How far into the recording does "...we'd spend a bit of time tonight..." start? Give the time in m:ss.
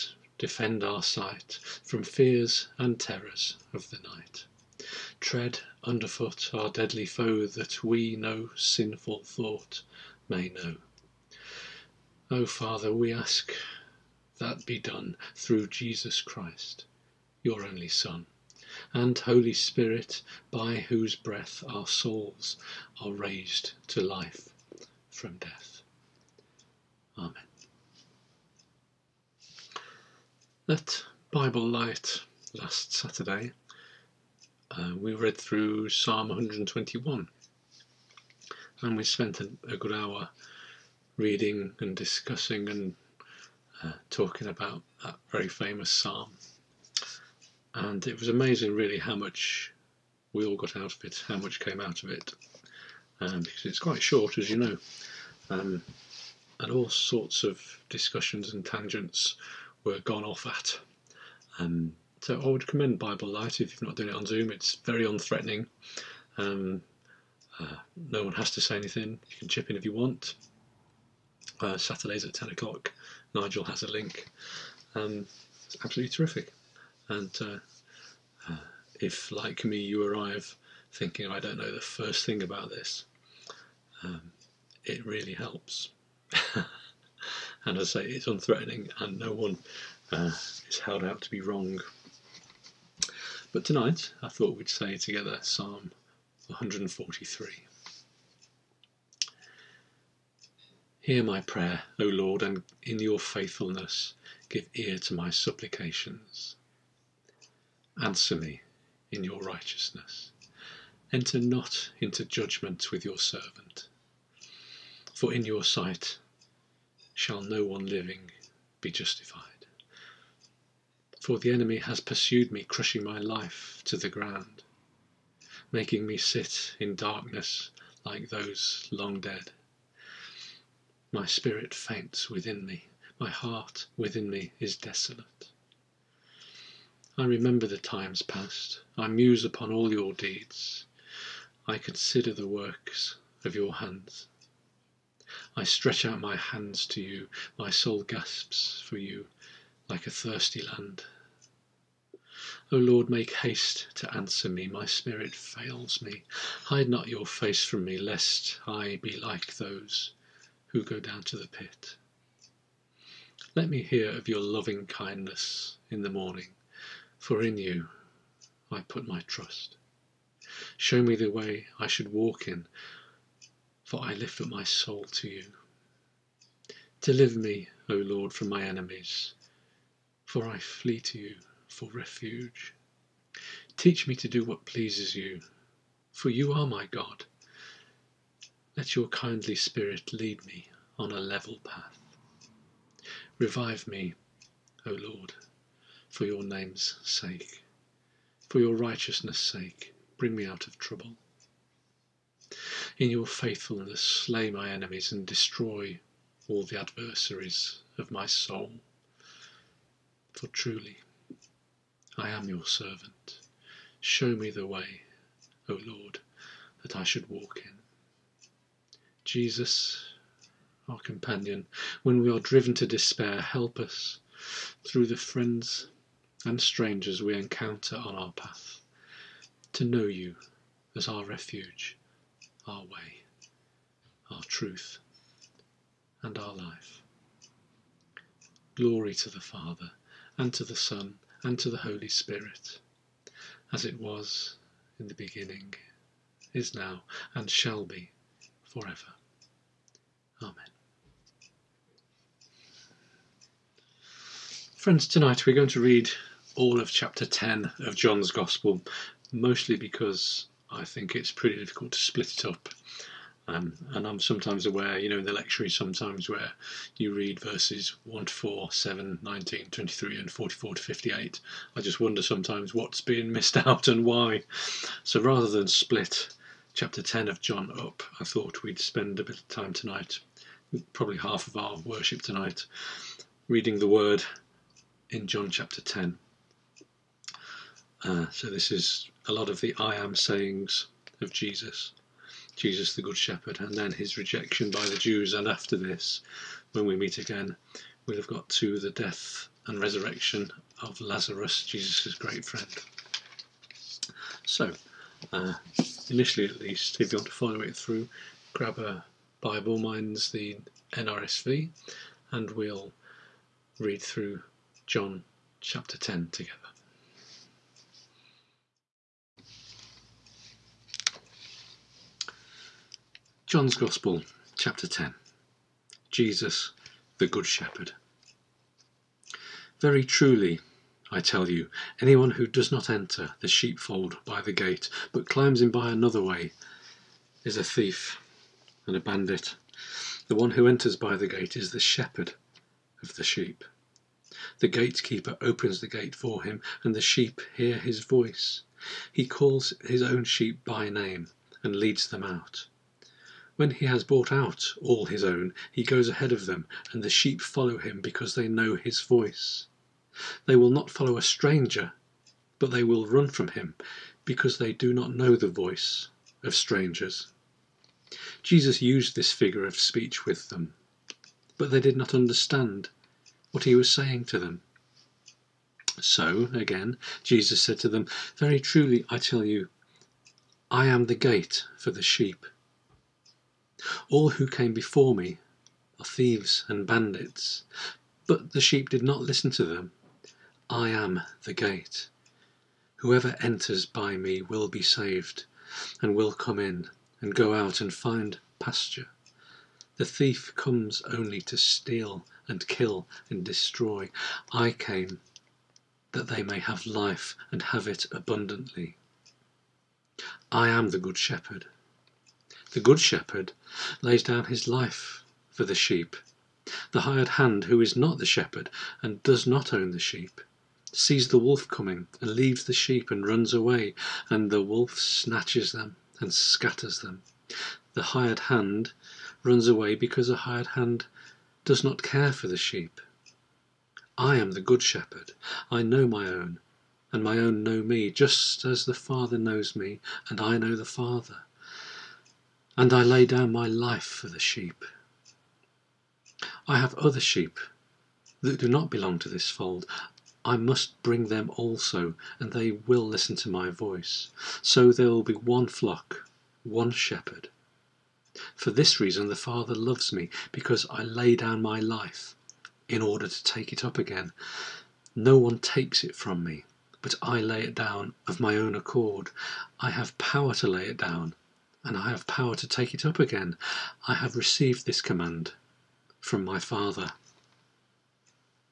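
4:38.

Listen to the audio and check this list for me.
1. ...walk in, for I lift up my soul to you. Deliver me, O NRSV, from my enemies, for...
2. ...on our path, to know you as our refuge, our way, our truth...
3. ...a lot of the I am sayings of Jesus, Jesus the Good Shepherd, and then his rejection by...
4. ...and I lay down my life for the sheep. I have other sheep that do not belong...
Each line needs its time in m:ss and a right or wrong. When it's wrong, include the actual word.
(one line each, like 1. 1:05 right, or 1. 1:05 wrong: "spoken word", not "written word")
1. 2:52 wrong: "Lord", not "NRSV"
2. 3:47 right
3. 4:49 right
4. 7:22 right.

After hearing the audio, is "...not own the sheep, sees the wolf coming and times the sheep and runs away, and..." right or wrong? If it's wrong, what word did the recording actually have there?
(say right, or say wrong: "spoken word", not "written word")
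wrong: "leaves", not "times".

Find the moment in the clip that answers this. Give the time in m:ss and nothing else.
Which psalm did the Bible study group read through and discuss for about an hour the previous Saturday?
0:35.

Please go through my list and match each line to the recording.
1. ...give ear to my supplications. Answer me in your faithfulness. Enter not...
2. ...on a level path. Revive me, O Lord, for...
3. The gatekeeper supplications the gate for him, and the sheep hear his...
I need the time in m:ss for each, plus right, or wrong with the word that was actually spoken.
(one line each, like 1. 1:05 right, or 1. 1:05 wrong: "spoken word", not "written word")
1. 1:44 wrong: "righteousness", not "faithfulness"
2. 3:10 right
3. 5:44 wrong: "opens", not "supplications".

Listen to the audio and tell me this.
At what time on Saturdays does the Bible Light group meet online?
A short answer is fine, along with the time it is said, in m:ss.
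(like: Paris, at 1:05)
10 o'clock, at 1:12.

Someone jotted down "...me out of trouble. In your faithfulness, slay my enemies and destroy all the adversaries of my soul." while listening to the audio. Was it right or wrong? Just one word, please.
right.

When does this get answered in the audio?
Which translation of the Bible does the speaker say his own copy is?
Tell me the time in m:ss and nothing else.
5:10.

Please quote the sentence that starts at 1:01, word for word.
Um, so I would commend Bible Light if you are not doing it on Zoom.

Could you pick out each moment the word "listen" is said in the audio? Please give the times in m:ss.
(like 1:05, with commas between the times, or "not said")
6:29, 7:33.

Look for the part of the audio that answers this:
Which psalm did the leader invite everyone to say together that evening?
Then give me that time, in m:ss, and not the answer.
1:35.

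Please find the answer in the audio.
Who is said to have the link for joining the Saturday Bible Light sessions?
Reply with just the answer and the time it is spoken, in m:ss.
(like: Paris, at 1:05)
Nigel, at 1:13.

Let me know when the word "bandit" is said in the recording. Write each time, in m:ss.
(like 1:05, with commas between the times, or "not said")
5:38, 6:26.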